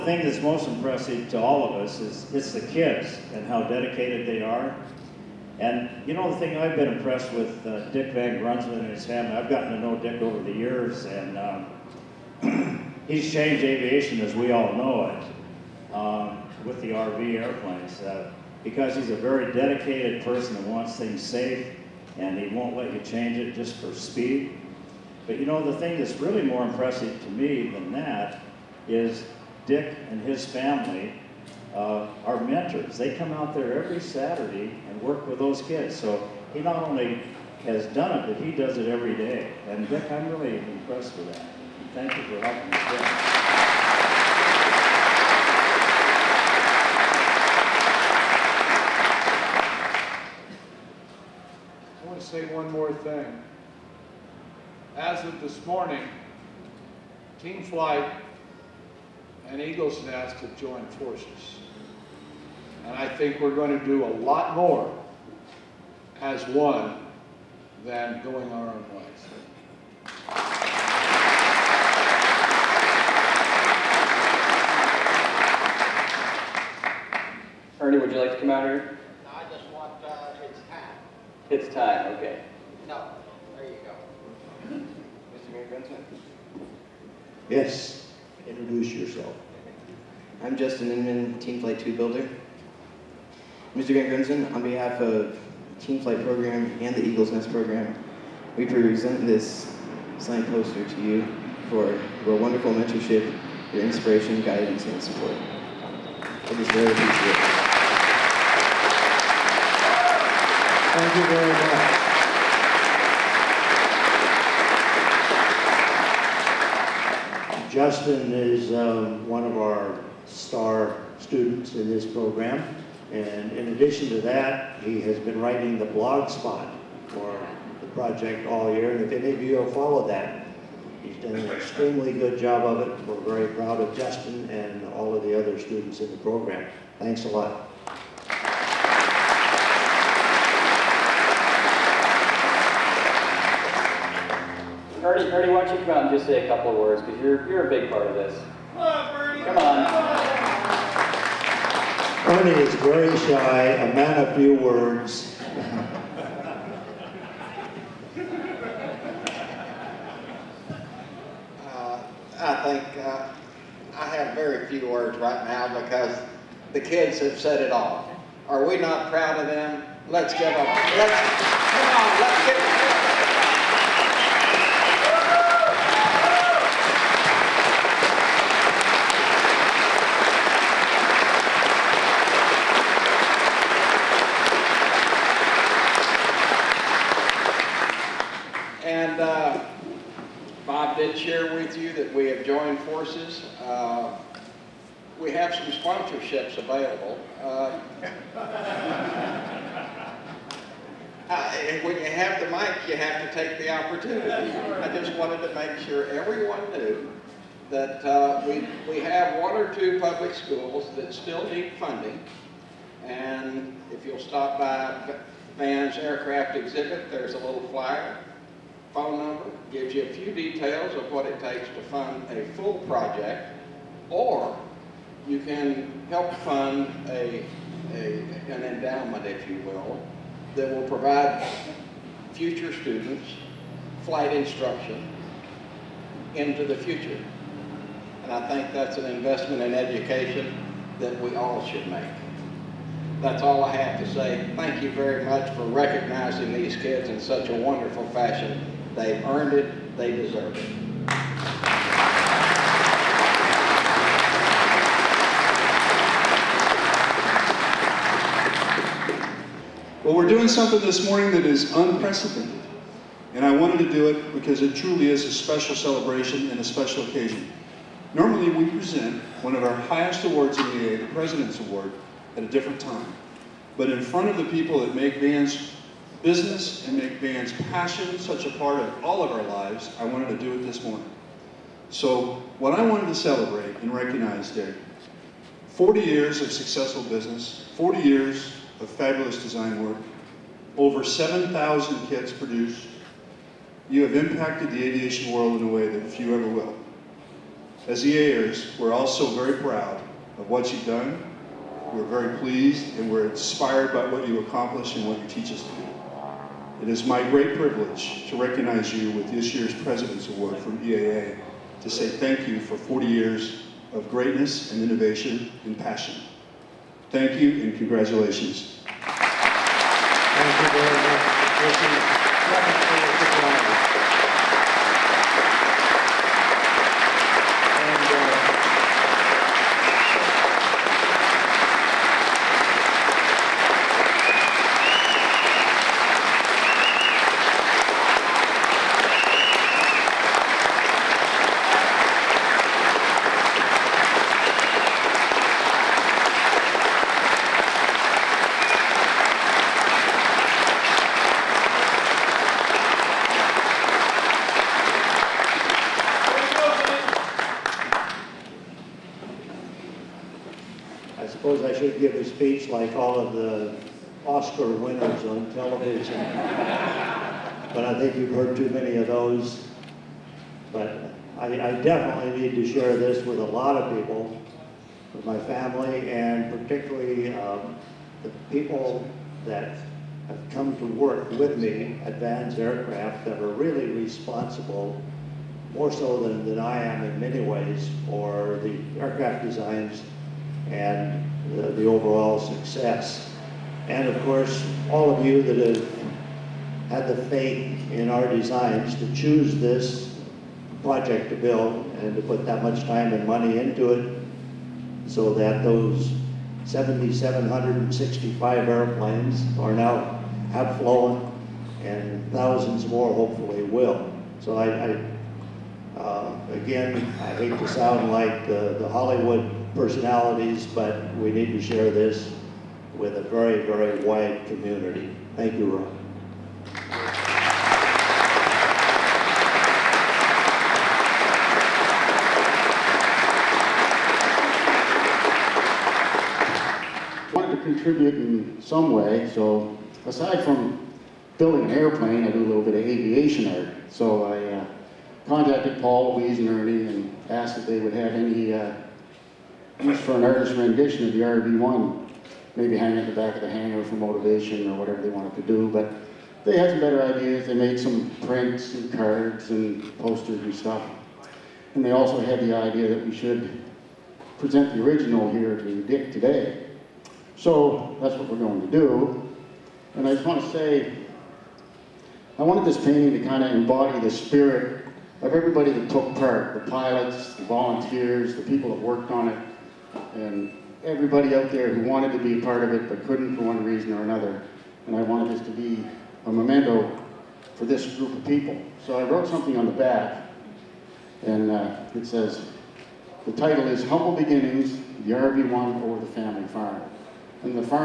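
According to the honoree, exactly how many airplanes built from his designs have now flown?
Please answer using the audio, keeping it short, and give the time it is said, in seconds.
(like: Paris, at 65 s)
7,765, at 406 s.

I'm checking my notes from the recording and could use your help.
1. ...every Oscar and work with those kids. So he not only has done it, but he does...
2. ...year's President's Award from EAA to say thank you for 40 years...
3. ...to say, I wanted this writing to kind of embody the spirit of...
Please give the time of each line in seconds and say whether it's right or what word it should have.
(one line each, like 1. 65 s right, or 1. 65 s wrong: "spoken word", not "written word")
1. 33 s wrong: "Saturday", not "Oscar"
2. 309 s right
3. 470 s wrong: "painting", not "writing".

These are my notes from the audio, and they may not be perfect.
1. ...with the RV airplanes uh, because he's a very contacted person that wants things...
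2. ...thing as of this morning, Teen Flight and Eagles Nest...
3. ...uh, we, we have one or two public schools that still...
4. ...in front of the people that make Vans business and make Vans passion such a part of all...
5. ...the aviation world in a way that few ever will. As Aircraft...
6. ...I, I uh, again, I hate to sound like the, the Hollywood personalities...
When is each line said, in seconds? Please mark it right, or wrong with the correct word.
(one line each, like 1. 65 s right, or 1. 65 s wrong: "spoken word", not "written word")
1. 16 s wrong: "dedicated", not "contacted"
2. 52 s right
3. 208 s right
4. 273 s right
5. 294 s wrong: "EAers", not "Aircraft"
6. 414 s right.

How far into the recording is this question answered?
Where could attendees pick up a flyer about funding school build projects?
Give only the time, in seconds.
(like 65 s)
215 s.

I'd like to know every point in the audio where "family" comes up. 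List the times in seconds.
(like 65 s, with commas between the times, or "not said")
9 s, 30 s, 375 s, 496 s.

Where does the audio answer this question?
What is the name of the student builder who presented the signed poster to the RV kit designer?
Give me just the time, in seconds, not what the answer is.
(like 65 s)
90 s.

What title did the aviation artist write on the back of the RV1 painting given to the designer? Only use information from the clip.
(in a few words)
Humble Beginnings.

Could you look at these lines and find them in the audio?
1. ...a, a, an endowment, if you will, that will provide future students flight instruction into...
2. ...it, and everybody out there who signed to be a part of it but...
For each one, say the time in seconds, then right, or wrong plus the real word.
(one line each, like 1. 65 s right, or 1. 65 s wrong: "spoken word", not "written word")
1. 227 s right
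2. 479 s wrong: "wanted", not "signed".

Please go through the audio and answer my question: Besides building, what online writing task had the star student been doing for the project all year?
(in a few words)
the blog spot.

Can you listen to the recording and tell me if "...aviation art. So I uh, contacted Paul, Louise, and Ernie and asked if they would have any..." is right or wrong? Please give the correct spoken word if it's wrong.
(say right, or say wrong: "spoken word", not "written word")
right.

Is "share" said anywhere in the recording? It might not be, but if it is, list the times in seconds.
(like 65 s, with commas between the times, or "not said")
372 s, 421 s.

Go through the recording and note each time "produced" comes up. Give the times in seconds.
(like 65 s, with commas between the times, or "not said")
292 s.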